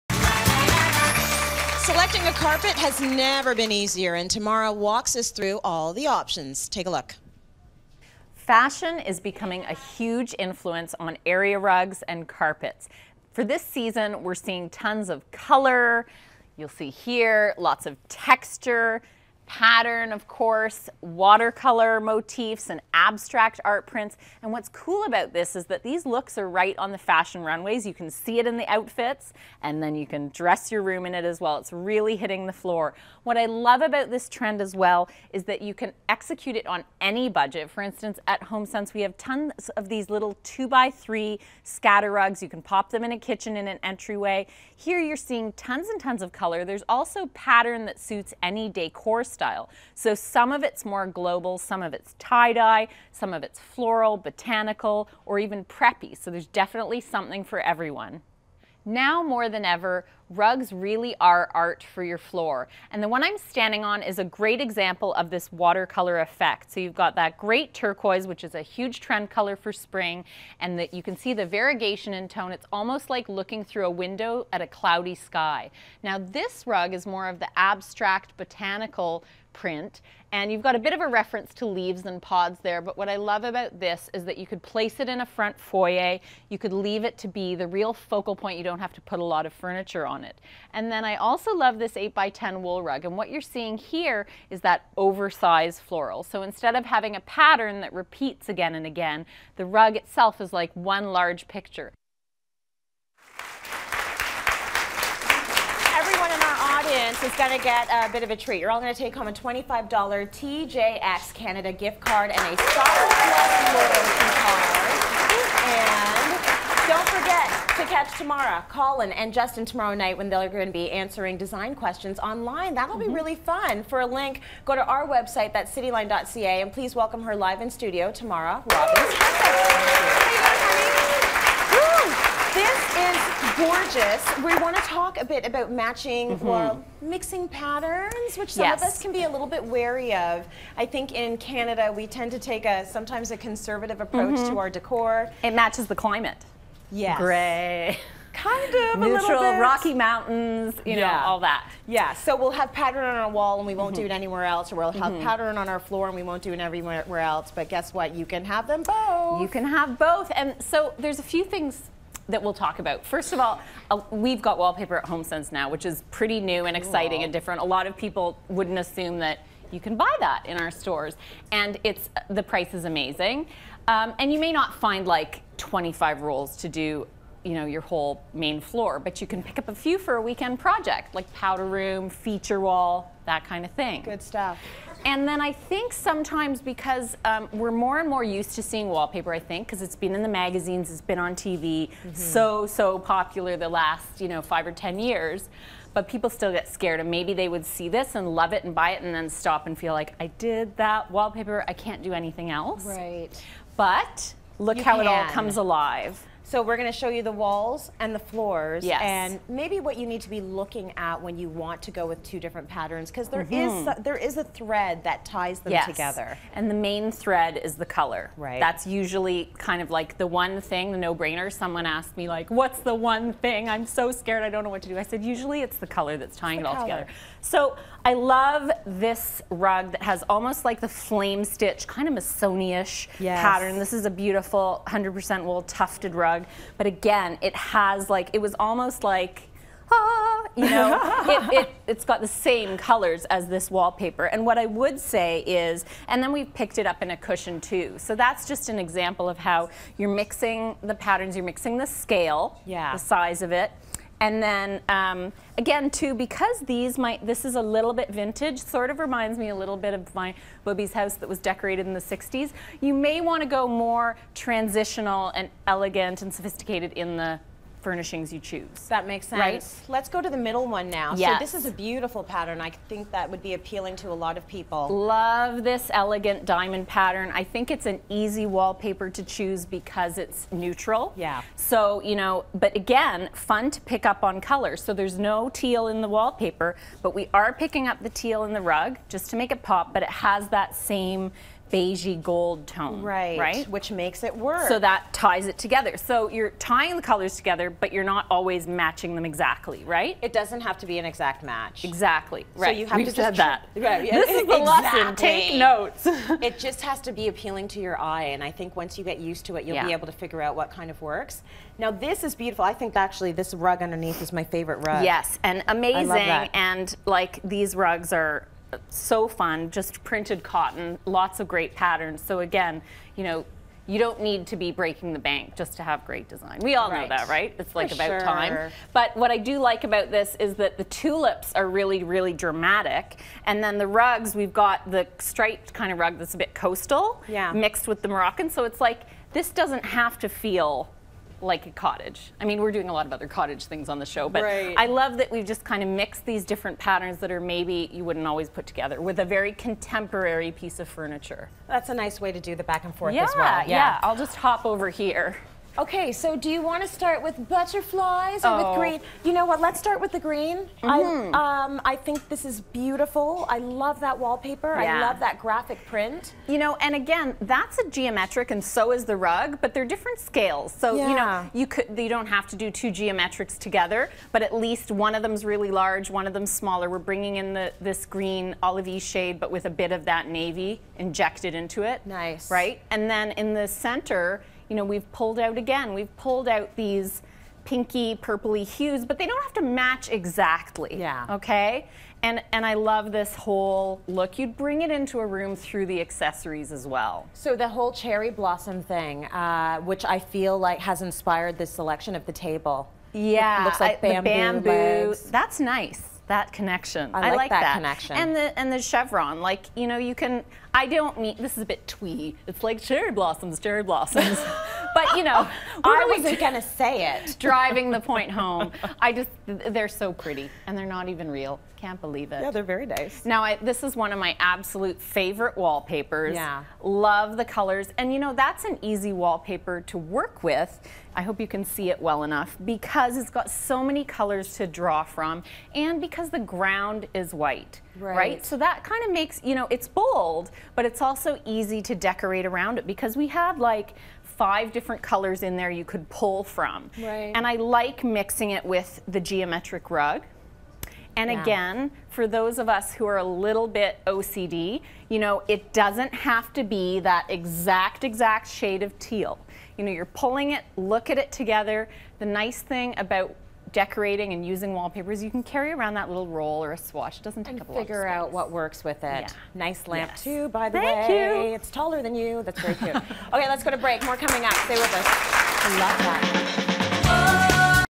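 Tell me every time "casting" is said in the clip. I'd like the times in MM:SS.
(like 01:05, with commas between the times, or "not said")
not said.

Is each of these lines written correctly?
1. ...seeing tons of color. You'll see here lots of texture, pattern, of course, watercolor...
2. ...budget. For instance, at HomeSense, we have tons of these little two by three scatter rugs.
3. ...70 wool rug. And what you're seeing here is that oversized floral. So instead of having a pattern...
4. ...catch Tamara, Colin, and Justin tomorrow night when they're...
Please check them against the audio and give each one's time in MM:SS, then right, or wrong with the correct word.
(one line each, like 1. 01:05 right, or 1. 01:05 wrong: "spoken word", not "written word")
1. 00:14 right
2. 00:37 right
3. 01:32 wrong: "10", not "70"
4. 01:57 right.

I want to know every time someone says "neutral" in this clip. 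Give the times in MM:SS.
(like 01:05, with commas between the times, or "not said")
02:28, 04:40.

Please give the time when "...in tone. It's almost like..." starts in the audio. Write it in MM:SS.
01:12.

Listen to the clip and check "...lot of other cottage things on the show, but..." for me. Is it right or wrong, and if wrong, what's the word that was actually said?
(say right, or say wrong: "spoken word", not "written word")
right.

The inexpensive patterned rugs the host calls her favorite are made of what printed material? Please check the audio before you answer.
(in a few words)
cotton.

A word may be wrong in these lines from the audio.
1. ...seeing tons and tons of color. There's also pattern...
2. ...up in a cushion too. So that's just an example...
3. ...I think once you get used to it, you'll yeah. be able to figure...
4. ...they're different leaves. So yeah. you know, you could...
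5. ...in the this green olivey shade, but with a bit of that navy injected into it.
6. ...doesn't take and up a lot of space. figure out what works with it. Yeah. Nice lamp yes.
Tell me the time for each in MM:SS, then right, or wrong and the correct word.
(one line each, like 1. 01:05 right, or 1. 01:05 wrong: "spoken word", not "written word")
1. 00:45 right
2. 04:06 right
3. 05:08 right
4. 06:09 wrong: "scales", not "leaves"
5. 06:17 right
6. 07:47 right.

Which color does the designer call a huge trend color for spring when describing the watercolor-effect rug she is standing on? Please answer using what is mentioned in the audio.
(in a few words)
turquoise.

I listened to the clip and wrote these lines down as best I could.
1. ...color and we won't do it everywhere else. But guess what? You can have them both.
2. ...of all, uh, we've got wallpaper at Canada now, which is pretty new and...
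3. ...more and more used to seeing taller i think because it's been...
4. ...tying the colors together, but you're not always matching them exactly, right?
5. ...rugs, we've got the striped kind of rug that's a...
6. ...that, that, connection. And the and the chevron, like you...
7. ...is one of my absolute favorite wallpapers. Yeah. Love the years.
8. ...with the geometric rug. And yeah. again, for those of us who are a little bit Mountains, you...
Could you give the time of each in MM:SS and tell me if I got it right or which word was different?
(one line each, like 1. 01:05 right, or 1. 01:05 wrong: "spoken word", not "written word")
1. 02:35 wrong: "floor", not "color"
2. 02:43 wrong: "HomeSense", not "Canada"
3. 03:07 wrong: "wallpaper", not "taller"
4. 04:56 right
5. 05:33 right
6. 06:47 right
7. 07:03 wrong: "colors", not "years"
8. 07:28 wrong: "OCD", not "Mountains".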